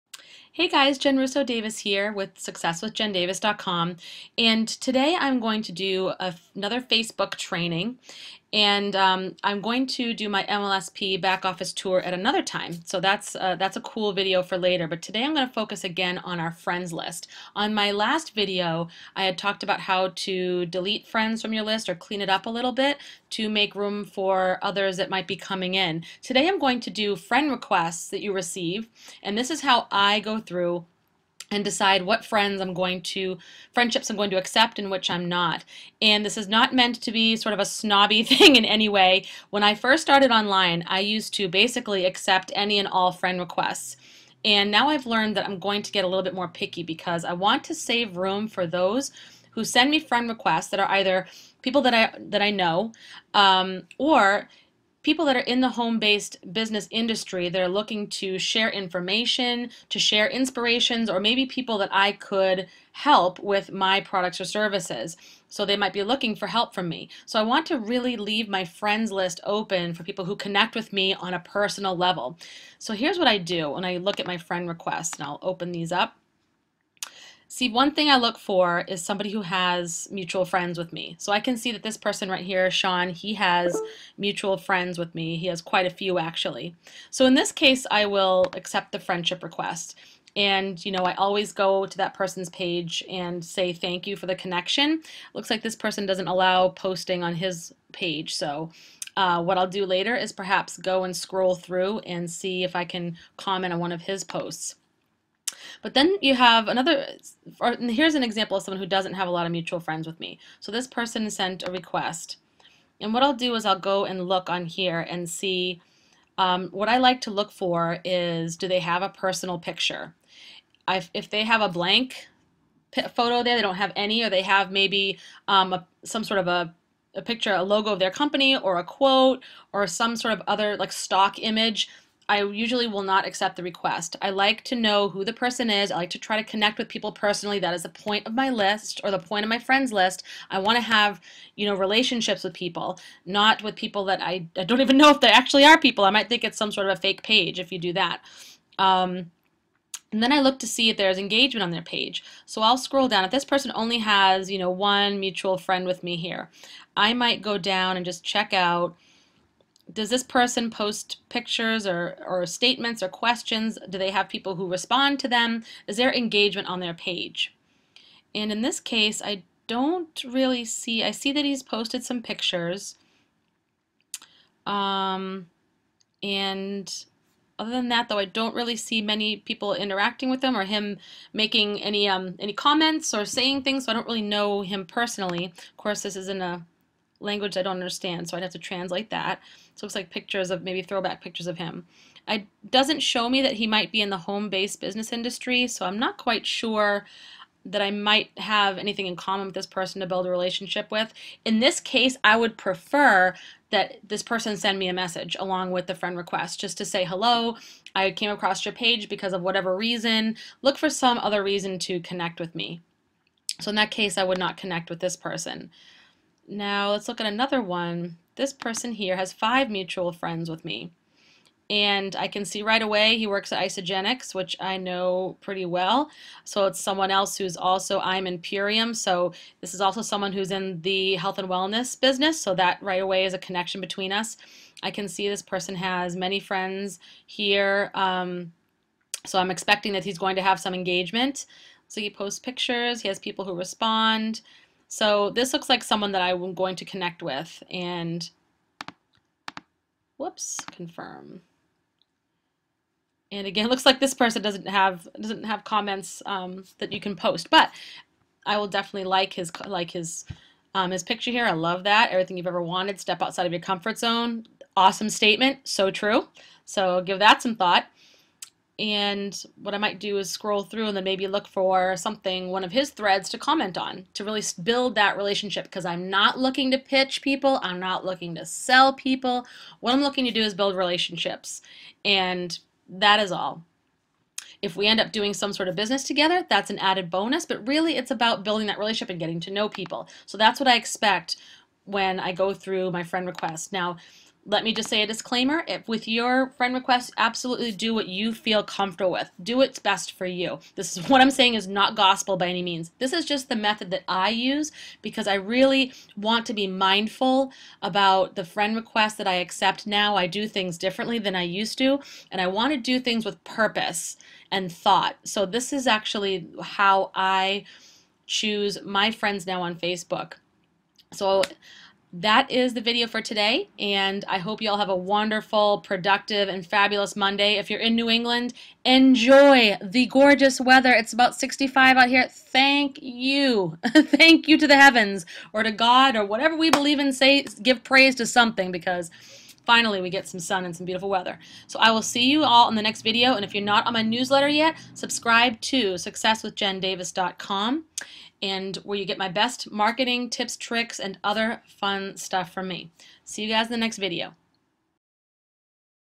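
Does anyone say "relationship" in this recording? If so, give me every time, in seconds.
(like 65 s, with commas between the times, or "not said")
141 s, 200 s, 275 s, 280 s, 288 s.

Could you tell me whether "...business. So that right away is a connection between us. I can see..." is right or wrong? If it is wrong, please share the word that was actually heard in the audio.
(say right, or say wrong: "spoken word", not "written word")
right.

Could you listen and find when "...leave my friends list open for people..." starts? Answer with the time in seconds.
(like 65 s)
68 s.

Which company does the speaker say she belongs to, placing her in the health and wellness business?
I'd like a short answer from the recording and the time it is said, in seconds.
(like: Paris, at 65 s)
Purium, at 228 s.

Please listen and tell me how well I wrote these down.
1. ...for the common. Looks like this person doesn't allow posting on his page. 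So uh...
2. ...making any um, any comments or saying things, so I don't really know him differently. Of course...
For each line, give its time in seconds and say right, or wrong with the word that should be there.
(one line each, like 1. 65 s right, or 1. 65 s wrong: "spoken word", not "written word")
1. 94 s wrong: "connection", not "common"
2. 181 s wrong: "personally", not "differently".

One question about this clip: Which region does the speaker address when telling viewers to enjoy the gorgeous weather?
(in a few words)
New England.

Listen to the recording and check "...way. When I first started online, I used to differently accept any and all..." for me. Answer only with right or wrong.
wrong.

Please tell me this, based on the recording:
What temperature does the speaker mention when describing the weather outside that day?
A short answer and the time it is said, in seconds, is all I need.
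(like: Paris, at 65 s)
65, at 331 s.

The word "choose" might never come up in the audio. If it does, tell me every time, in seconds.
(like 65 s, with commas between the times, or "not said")
318 s.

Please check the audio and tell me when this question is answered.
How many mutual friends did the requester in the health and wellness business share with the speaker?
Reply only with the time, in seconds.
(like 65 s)
219 s.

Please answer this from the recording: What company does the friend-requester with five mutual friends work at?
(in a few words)
Isagenix.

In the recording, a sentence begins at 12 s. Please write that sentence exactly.
So that's, uh, that's a cool video for later, but today I'm going to focus again on our friends list.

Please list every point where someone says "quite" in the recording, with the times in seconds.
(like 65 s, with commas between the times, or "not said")
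85 s, 196 s.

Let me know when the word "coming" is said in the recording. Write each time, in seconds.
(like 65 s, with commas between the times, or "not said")
25 s.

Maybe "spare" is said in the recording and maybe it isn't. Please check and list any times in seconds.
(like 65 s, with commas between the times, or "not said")
not said.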